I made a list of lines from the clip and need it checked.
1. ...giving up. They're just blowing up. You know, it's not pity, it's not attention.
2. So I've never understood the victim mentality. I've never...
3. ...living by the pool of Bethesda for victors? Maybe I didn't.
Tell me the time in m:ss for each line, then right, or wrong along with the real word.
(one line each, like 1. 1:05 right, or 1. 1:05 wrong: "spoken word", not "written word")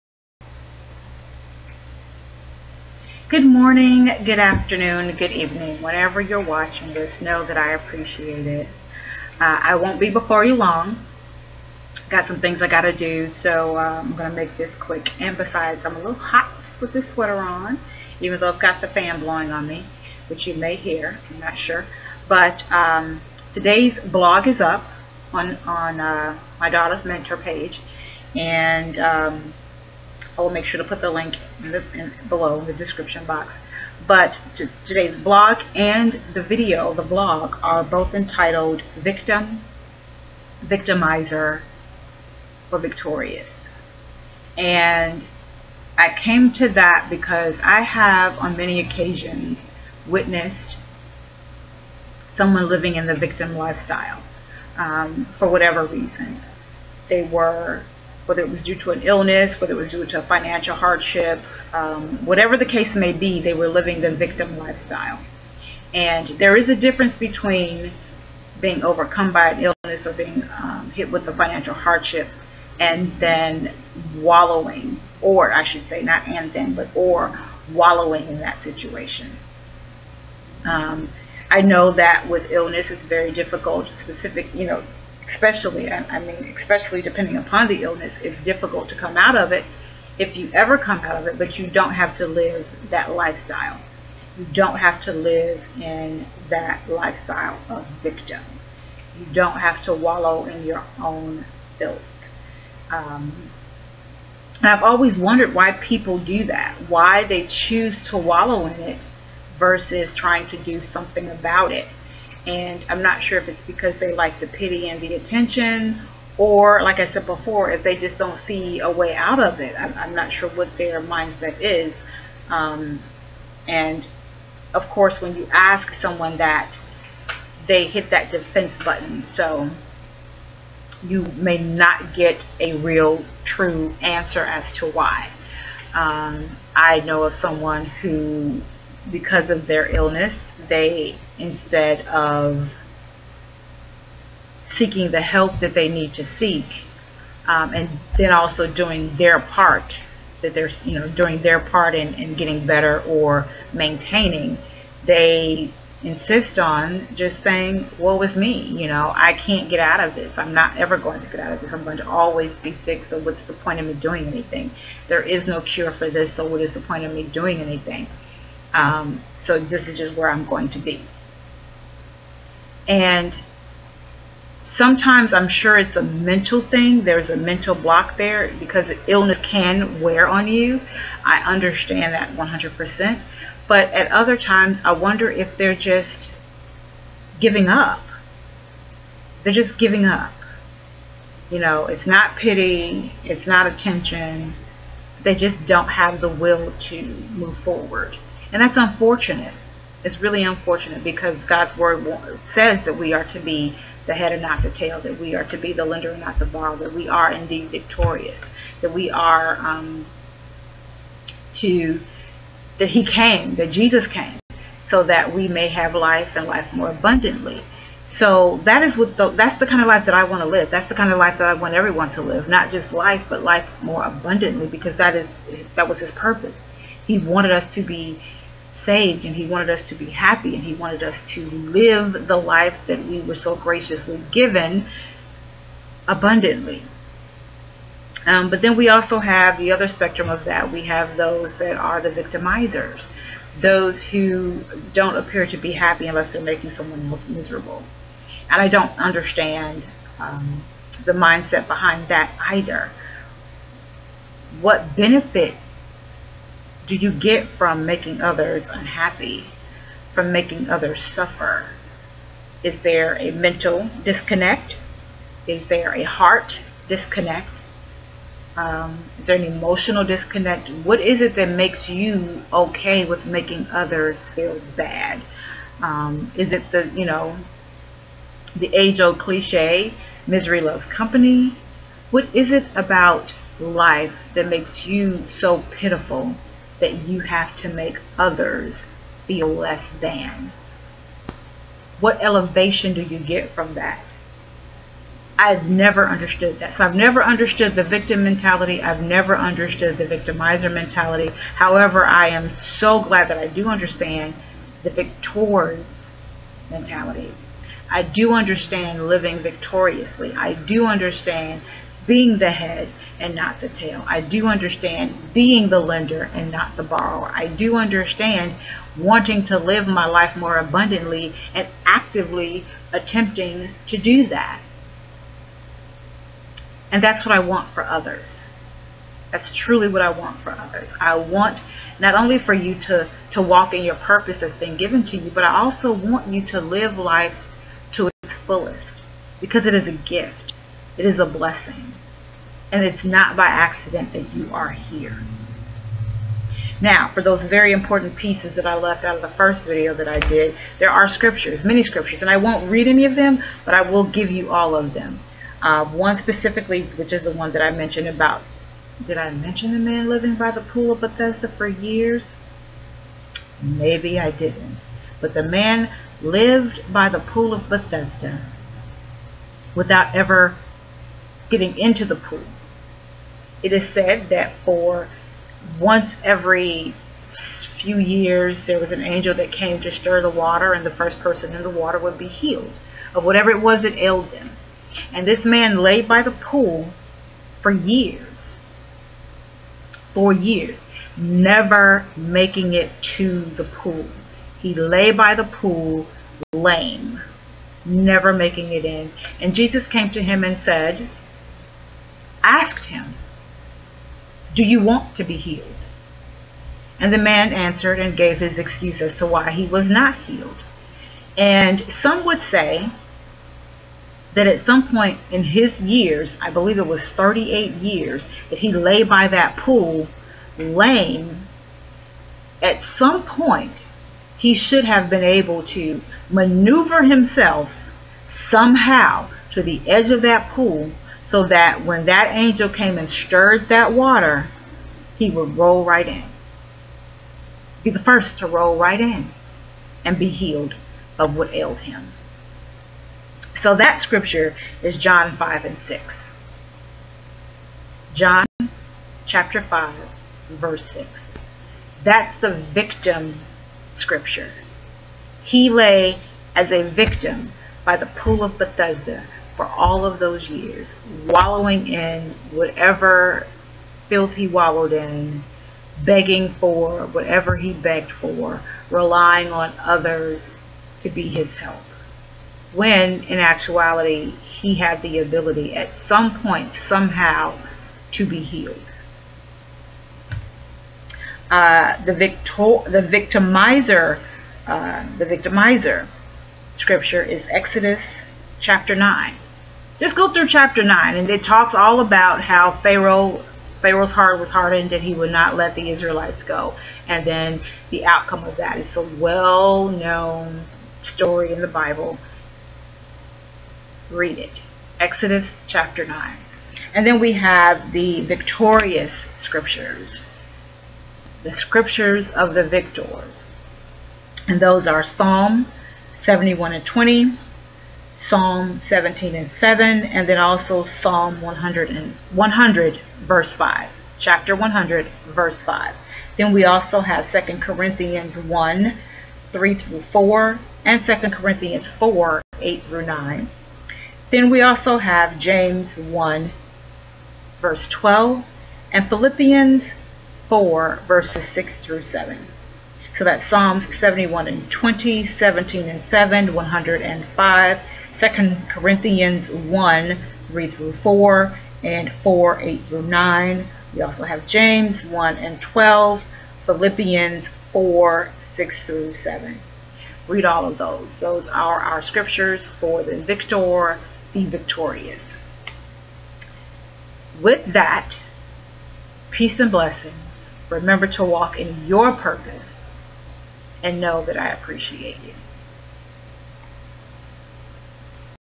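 1. 3:07 wrong: "giving", not "blowing"
2. 4:56 right
3. 6:00 wrong: "years", not "victors".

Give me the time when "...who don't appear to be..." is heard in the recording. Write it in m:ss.
4:04.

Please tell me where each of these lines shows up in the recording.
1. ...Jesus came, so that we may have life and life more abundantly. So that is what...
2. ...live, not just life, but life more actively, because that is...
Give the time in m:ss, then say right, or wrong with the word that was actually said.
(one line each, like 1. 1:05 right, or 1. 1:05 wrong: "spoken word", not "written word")
1. 3:33 right
2. 3:42 wrong: "abundantly", not "actively".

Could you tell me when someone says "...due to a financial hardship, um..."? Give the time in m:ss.
0:59.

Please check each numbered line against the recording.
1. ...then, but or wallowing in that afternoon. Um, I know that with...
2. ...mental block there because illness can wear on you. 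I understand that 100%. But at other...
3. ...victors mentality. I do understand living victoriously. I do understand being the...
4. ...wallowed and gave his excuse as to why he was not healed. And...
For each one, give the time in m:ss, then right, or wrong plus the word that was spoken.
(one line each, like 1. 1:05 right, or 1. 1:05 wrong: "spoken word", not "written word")
1. 1:16 wrong: "situation", not "afternoon"
2. 2:57 right
3. 5:04 right
4. 6:47 wrong: "answered", not "wallowed".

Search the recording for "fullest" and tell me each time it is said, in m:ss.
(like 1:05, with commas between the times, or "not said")
5:38.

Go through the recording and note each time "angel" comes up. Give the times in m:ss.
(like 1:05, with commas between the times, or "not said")
6:19, 7:12.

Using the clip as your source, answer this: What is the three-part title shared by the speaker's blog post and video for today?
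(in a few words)
Victim, Victimizer, or Victorious.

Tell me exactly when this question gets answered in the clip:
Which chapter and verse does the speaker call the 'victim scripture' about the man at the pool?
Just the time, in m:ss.
7:28.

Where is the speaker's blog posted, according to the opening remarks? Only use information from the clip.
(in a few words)
Daughter's mentor page.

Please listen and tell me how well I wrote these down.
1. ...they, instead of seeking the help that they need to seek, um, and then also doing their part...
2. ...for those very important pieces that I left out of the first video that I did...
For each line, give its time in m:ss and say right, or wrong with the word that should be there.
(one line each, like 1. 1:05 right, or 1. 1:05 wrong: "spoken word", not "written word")
1. 2:20 right
2. 5:47 right.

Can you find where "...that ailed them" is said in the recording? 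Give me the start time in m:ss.
6:23.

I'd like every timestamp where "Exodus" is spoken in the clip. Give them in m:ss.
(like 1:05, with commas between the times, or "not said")
8:07, 8:24.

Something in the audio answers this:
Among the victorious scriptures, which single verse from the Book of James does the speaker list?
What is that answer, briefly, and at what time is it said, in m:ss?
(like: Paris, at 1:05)
James 1:12, at 8:55.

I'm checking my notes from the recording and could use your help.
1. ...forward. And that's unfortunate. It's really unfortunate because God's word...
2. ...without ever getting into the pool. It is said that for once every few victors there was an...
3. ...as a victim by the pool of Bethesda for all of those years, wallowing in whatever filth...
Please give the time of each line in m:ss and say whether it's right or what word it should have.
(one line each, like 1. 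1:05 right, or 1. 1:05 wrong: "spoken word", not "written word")
1. 3:17 right
2. 6:09 wrong: "years", not "victors"
3. 7:36 right.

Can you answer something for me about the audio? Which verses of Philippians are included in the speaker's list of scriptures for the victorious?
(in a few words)
Philippians 4:6-7.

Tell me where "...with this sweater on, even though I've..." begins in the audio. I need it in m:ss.
0:16.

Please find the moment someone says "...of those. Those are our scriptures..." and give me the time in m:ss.
9:20.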